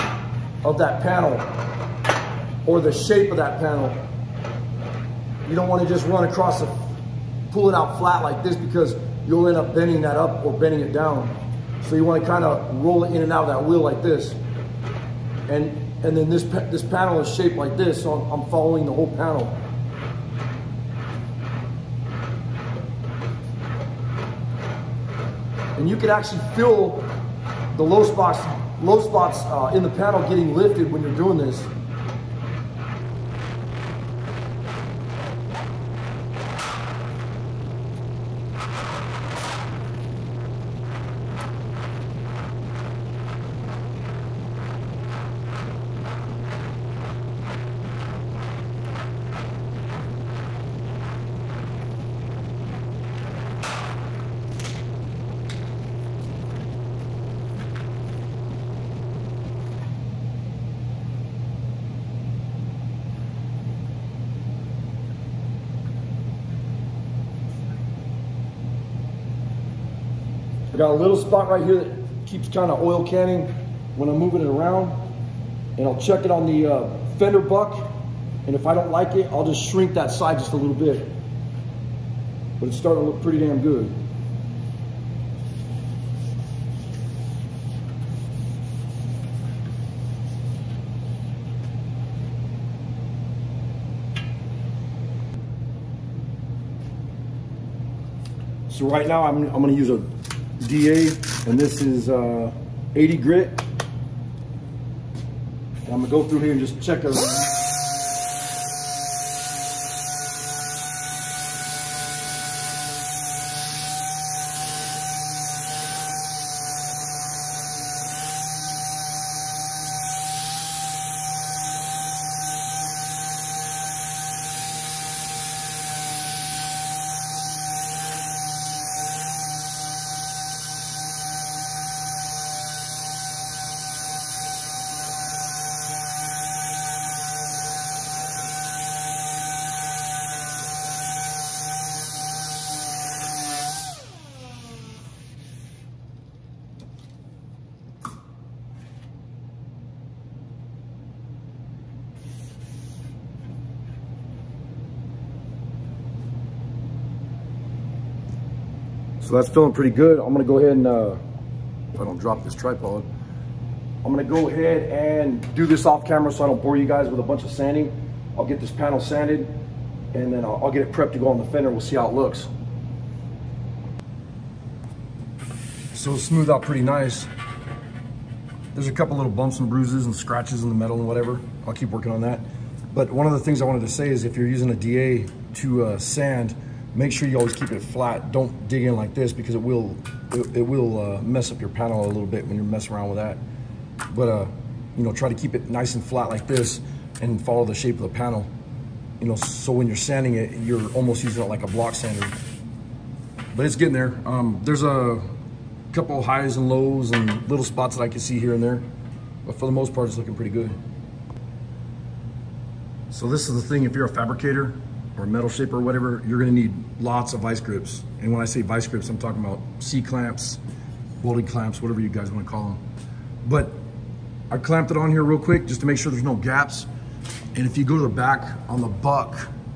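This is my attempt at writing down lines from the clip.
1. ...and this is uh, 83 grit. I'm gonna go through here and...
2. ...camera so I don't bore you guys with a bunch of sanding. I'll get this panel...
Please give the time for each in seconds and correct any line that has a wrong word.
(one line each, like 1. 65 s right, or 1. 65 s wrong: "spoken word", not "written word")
1. 101 s wrong: "80", not "83"
2. 166 s right.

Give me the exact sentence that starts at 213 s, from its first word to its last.
So this is the thing, if you're a fabricator, or metal shape or whatever, you're gonna need lots of vice grips.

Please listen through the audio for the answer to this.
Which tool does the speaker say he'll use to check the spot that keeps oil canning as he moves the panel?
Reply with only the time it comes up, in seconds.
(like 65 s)
77 s.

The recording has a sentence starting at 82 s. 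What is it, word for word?
But it's starting to look pretty damn good.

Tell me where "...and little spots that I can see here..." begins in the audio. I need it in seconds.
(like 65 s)
207 s.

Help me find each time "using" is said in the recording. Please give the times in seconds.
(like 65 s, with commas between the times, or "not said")
184 s, 201 s.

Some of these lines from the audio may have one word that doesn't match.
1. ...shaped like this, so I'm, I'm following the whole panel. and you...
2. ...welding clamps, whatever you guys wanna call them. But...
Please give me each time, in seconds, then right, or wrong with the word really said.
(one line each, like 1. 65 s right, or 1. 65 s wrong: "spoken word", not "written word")
1. 17 s right
2. 221 s right.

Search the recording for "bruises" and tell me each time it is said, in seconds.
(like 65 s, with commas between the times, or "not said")
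179 s.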